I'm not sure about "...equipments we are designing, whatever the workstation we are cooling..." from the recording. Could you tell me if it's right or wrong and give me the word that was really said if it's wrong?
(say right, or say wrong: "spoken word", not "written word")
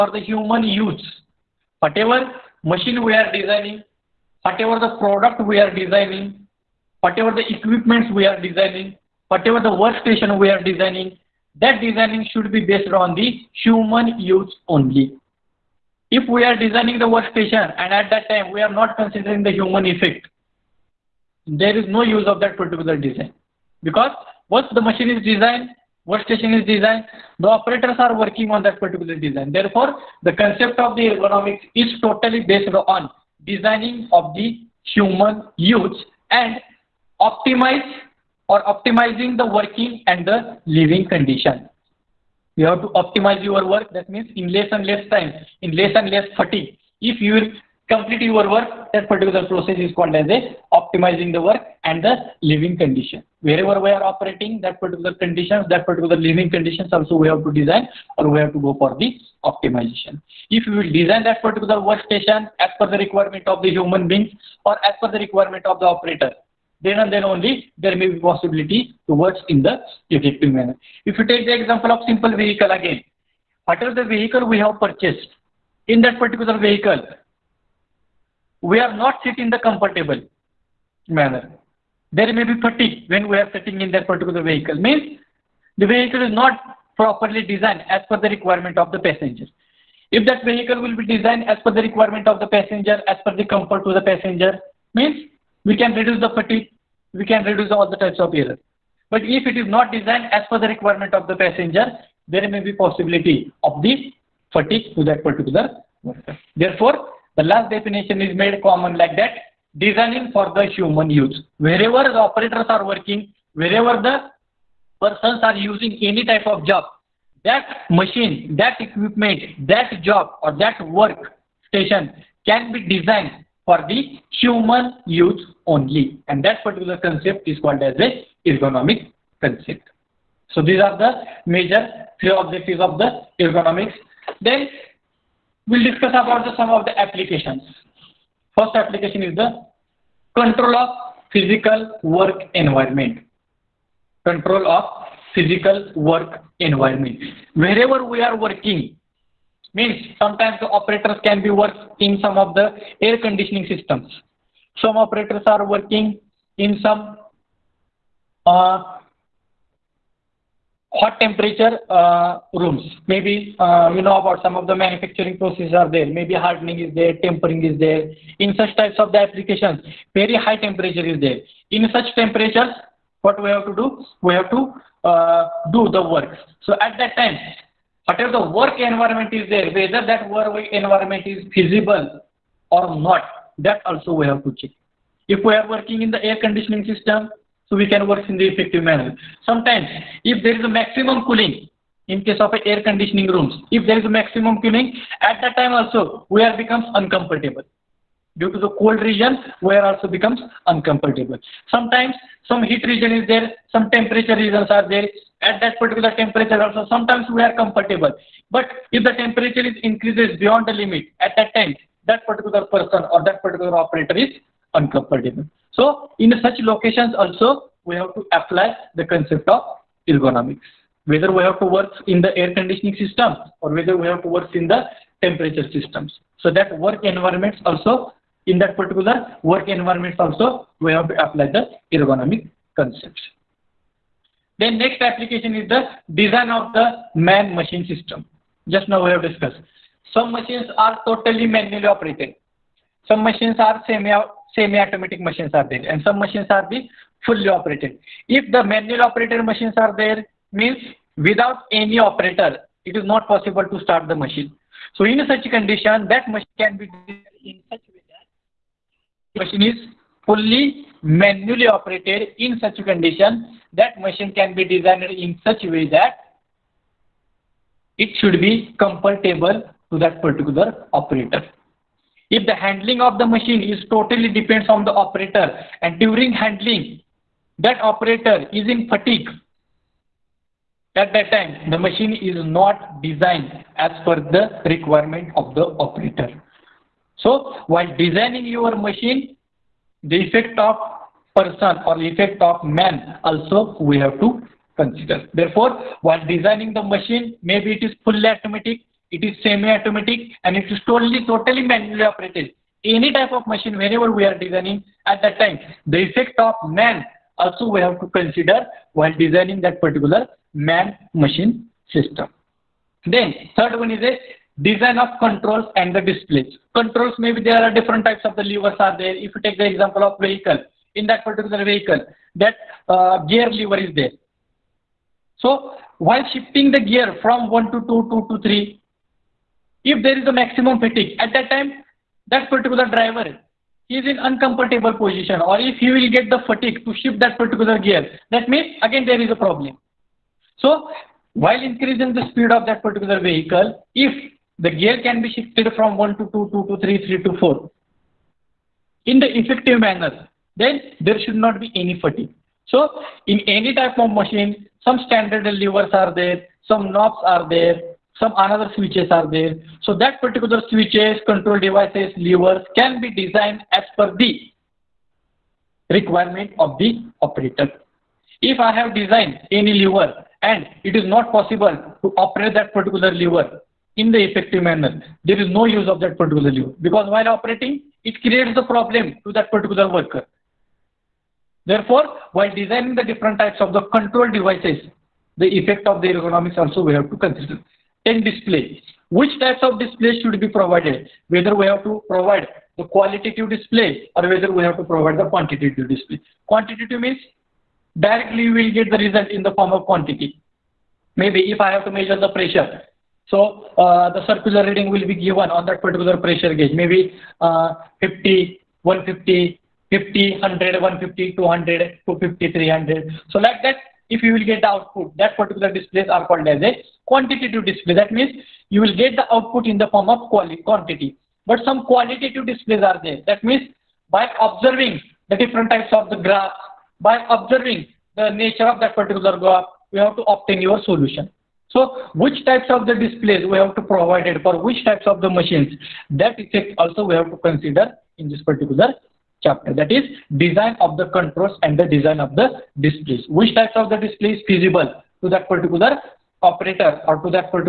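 wrong: "designing", not "cooling".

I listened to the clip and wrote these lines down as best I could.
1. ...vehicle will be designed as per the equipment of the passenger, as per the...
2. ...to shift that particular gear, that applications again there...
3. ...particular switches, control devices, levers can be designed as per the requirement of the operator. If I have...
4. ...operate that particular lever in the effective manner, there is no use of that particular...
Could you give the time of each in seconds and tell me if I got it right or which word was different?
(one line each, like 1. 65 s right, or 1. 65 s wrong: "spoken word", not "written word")
1. 90 s wrong: "requirement", not "equipment"
2. 336 s wrong: "means", not "applications"
3. 360 s right
4. 372 s right.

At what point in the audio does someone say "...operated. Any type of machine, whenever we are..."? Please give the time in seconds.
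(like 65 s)
302 s.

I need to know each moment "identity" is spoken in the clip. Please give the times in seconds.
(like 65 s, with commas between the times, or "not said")
not said.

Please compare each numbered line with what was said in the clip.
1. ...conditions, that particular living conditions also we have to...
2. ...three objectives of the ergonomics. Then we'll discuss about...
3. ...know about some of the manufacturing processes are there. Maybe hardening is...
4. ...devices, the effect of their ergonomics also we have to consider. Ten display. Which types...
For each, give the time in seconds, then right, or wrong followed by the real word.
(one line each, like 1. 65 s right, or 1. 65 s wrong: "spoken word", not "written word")
1. 55 s right
2. 132 s right
3. 164 s right
4. 384 s right.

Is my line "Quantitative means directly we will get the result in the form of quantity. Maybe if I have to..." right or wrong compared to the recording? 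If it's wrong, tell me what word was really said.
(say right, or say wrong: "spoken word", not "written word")
right.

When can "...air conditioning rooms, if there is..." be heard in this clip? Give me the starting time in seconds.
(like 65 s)
192 s.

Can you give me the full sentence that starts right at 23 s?
Because once the machine is designed, workstation is designed, the operators are working on that particular design.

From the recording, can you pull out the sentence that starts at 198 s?
Due to the cold region, we are also becomes uncomfortable.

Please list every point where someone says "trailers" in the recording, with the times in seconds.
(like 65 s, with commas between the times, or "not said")
not said.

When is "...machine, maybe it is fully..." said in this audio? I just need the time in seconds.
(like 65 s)
296 s.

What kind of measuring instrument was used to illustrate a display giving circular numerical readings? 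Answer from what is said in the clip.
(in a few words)
pressure gauge.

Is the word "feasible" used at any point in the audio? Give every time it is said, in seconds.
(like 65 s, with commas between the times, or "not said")
181 s, 444 s.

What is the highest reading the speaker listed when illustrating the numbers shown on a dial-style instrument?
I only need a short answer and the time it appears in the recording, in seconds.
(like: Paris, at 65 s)
300, at 412 s.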